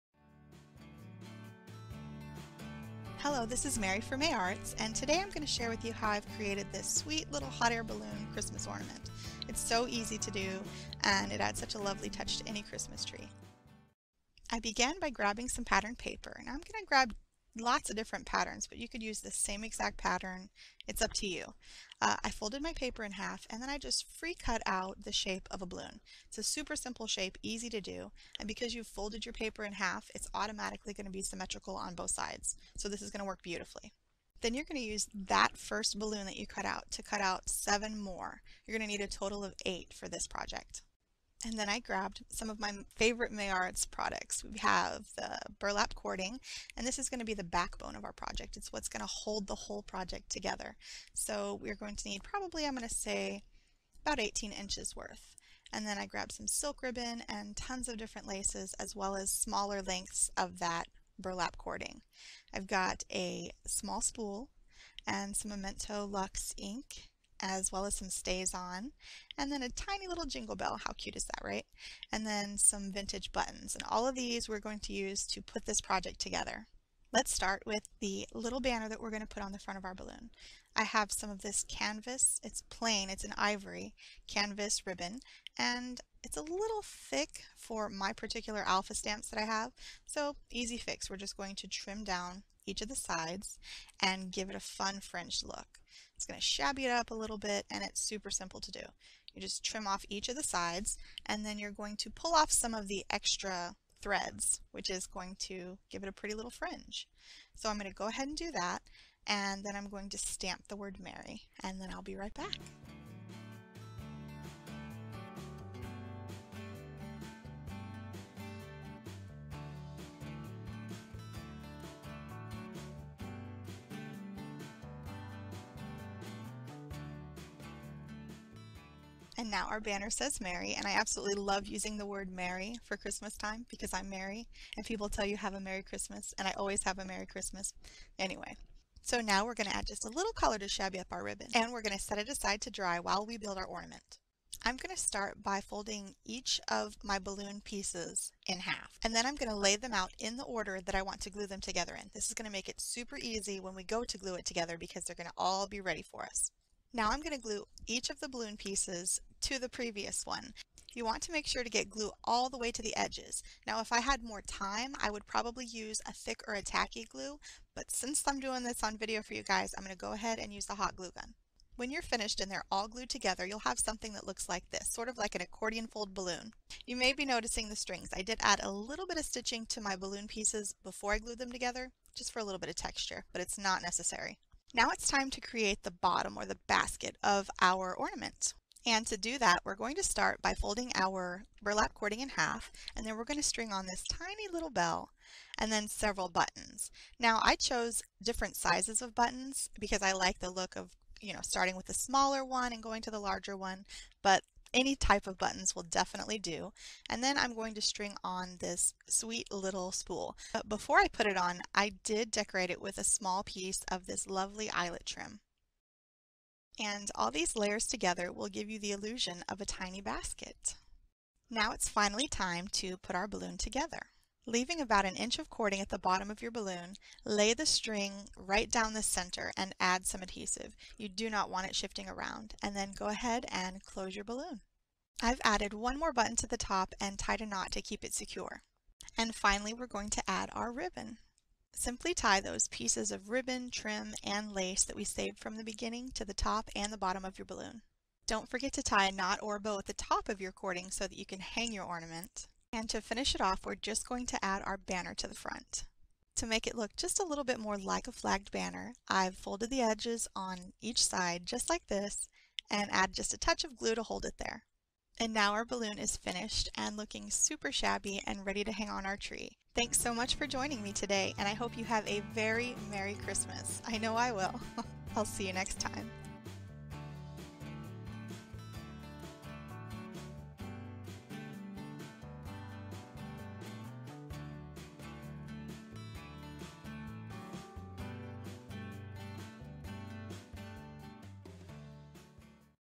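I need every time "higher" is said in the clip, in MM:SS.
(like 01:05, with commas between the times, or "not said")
not said.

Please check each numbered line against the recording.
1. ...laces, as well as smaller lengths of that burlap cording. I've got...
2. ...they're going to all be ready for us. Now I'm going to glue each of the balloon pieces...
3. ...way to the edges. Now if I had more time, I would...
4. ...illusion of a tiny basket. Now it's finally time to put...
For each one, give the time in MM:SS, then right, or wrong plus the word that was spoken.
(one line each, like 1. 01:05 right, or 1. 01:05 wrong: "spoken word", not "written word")
1. 00:58 right
2. 02:35 right
3. 02:42 right
4. 03:38 right.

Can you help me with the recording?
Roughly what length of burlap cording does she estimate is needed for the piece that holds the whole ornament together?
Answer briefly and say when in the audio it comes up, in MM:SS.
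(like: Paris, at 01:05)
18 inches, at 00:54.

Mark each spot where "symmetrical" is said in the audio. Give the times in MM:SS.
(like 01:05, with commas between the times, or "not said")
00:31.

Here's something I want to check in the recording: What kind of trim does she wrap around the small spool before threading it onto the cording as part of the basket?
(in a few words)
eyelet trim.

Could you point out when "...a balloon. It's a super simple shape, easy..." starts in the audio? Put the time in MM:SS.
00:25.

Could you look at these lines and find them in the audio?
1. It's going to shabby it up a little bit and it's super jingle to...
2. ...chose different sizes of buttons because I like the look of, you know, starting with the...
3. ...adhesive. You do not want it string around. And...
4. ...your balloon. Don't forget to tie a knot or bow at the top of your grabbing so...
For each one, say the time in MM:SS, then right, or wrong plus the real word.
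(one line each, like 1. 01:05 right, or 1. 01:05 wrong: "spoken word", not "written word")
1. 01:36 wrong: "simple", not "jingle"
2. 03:17 right
3. 03:50 wrong: "shifting", not "string"
4. 04:07 wrong: "cording", not "grabbing".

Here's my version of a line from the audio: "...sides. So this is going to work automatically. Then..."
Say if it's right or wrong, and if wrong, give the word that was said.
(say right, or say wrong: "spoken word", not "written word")
wrong: "beautifully", not "automatically".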